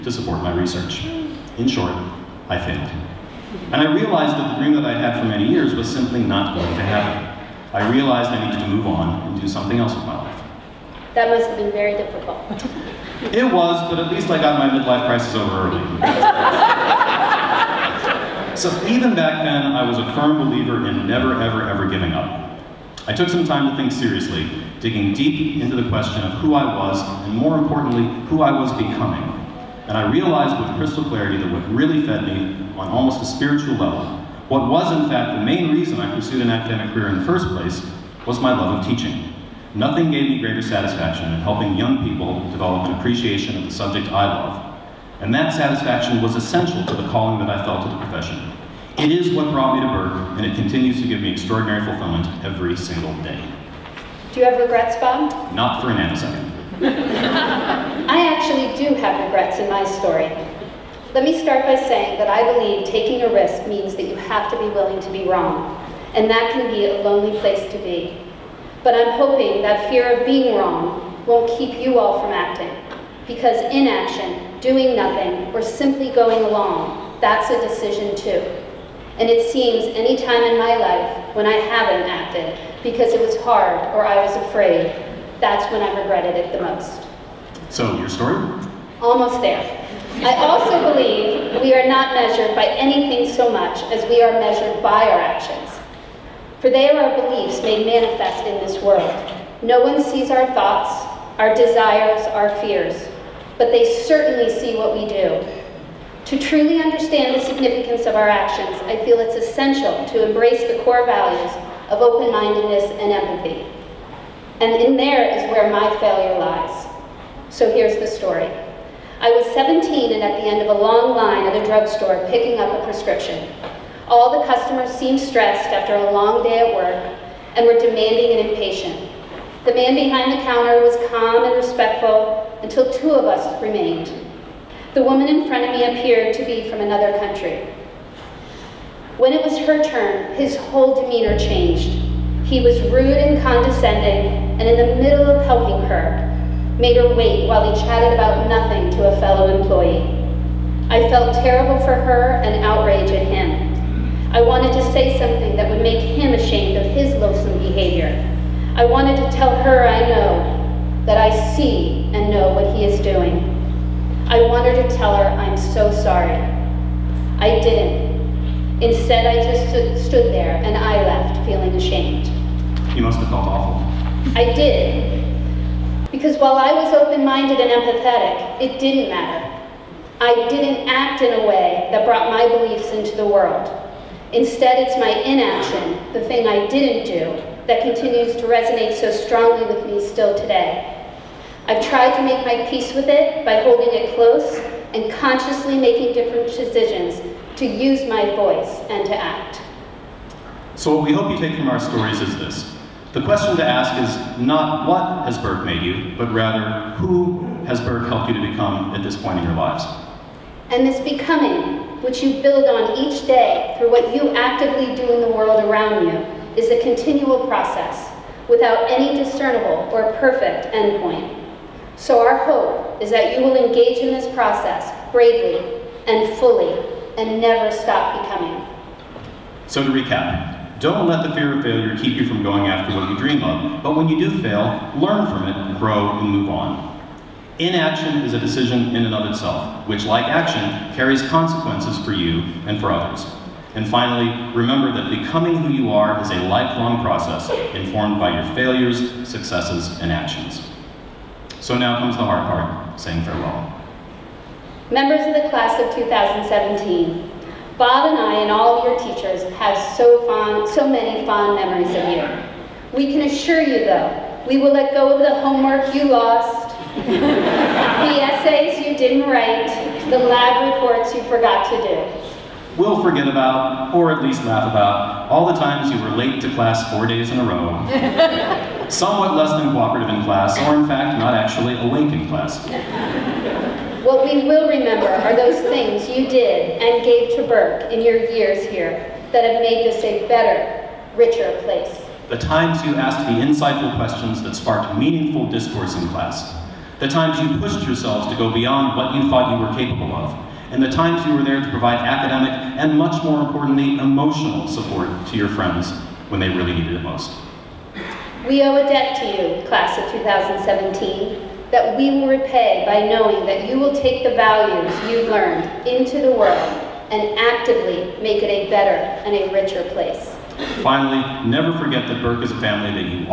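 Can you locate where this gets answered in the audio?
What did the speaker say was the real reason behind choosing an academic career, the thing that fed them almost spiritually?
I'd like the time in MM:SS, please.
00:38.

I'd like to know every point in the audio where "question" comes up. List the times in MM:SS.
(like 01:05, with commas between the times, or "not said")
00:25, 03:23, 04:53.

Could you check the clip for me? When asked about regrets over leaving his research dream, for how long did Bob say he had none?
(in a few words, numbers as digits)
a nanosecond.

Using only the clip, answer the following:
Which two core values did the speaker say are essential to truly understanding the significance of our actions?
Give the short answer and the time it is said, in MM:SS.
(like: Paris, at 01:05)
open-mindedness and empathy, at 01:52.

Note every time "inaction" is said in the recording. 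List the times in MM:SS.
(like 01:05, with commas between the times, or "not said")
01:13, 03:05, 03:57.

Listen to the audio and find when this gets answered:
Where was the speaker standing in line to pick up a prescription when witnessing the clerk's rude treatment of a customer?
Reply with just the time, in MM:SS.
02:01.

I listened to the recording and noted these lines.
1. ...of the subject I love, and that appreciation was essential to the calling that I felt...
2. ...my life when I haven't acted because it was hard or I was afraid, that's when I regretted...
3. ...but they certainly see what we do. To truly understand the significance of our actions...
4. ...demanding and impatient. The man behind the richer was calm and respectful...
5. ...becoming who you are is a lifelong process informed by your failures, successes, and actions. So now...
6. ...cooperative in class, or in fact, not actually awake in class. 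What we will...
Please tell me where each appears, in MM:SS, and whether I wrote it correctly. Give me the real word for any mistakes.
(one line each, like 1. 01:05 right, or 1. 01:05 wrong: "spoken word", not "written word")
1. 00:43 wrong: "satisfaction", not "appreciation"
2. 01:20 right
3. 01:43 right
4. 02:07 wrong: "counter", not "richer"
5. 04:05 right
6. 04:39 right.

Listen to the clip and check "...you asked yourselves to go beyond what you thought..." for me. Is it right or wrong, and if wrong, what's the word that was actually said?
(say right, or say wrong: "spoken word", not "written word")
wrong: "pushed", not "asked".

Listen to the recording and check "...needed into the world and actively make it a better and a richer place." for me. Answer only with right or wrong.
wrong.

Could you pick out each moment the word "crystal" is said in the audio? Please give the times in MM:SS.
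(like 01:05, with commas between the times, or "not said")
00:30.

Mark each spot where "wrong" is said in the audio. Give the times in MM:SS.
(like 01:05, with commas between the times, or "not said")
01:05, 01:10.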